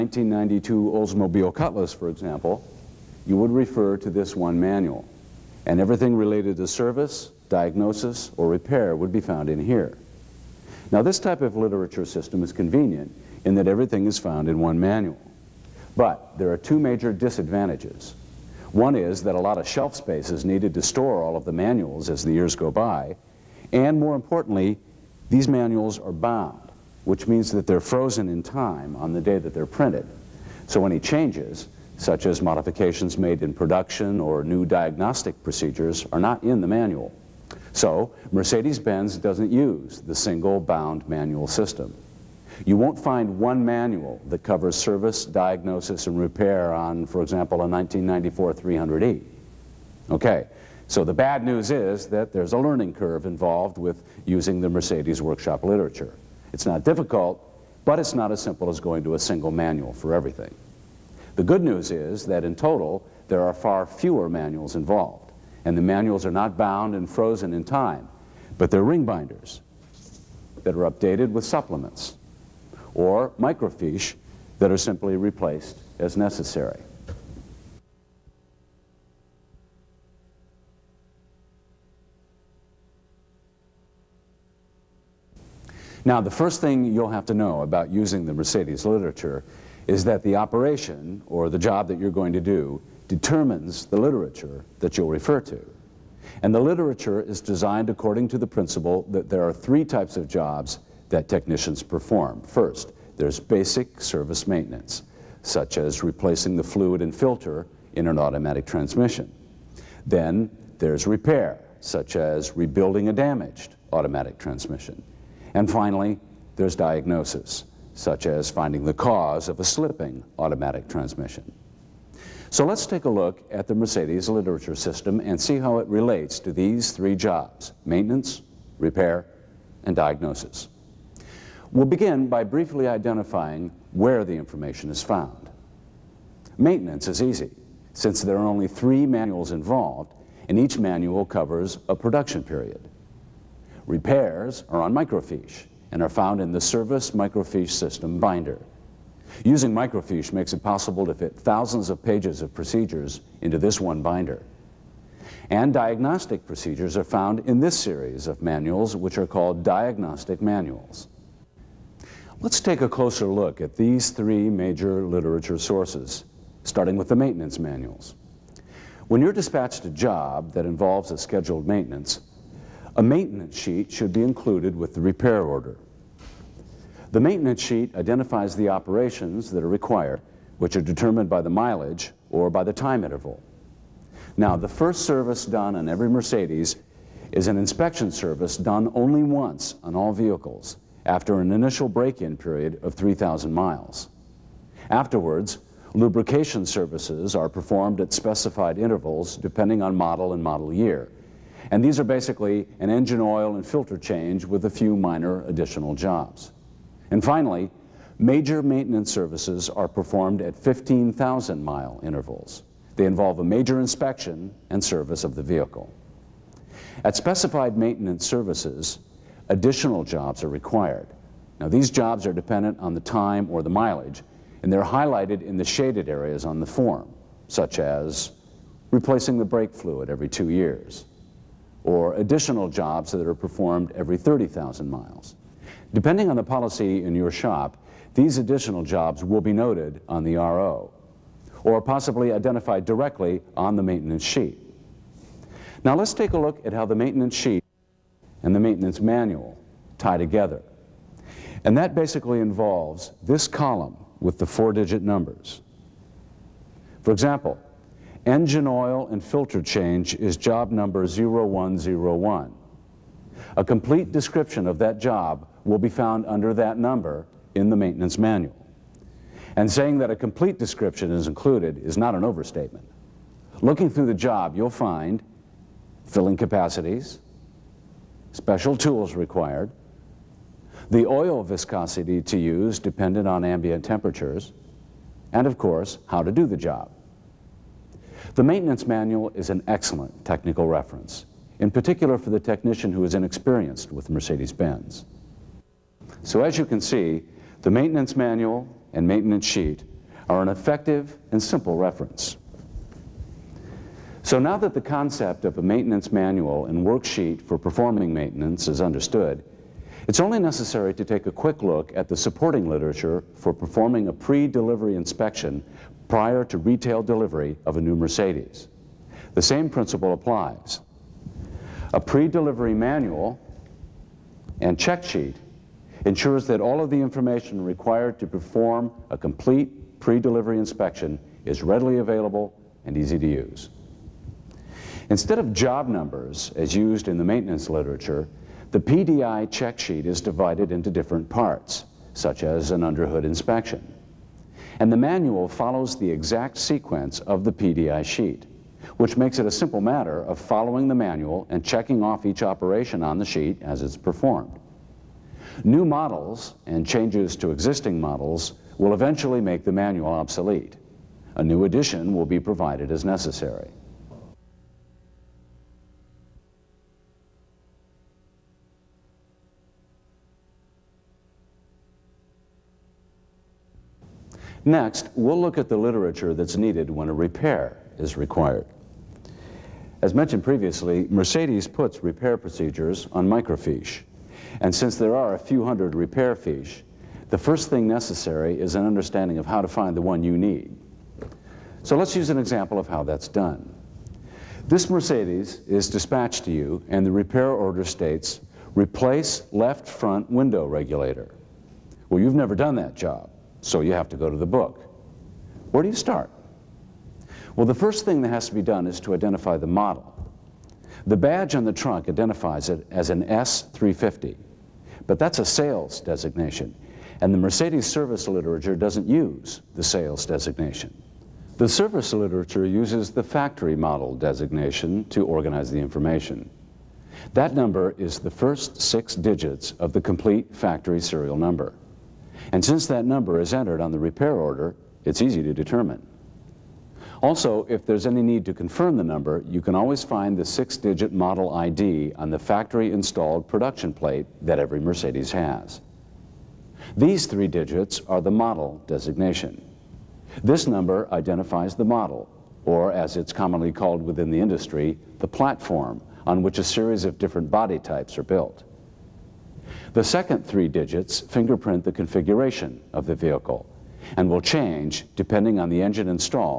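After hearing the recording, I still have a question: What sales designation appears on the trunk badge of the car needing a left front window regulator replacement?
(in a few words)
S350.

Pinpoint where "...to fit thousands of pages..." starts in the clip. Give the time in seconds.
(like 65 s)
151 s.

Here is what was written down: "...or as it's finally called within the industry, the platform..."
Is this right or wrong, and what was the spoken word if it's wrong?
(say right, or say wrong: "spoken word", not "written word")
wrong: "commonly", not "finally".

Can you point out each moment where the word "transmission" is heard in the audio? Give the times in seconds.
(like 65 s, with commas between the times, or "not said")
108 s, 114 s, 120 s.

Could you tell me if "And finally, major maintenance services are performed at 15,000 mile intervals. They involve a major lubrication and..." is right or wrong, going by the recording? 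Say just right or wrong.
wrong.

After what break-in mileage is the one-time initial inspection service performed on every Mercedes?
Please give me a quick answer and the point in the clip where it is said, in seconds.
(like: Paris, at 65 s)
3,000 miles, at 192 s.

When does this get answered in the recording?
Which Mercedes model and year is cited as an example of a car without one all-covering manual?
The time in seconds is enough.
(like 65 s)
47 s.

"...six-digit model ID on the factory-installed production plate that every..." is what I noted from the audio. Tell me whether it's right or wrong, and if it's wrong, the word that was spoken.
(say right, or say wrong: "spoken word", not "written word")
right.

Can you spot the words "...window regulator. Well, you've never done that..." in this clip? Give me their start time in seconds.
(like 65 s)
400 s.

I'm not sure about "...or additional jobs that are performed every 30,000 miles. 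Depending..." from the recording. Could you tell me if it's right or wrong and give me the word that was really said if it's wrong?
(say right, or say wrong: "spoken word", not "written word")
right.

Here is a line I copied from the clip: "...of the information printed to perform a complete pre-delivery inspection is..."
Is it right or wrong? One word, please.
wrong.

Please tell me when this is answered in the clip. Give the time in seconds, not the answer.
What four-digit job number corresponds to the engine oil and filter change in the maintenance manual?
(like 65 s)
261 s.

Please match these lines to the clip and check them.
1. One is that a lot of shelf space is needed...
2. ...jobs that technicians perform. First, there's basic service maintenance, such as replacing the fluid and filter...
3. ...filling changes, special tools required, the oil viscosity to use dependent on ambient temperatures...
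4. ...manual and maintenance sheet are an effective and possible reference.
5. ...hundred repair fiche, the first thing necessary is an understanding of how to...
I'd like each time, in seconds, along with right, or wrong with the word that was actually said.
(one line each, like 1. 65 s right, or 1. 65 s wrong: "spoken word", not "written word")
1. 18 s right
2. 100 s right
3. 276 s wrong: "capacities", not "changes"
4. 298 s wrong: "simple", not "possible"
5. 385 s right.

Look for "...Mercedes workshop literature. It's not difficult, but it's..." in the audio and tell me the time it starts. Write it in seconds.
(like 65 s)
54 s.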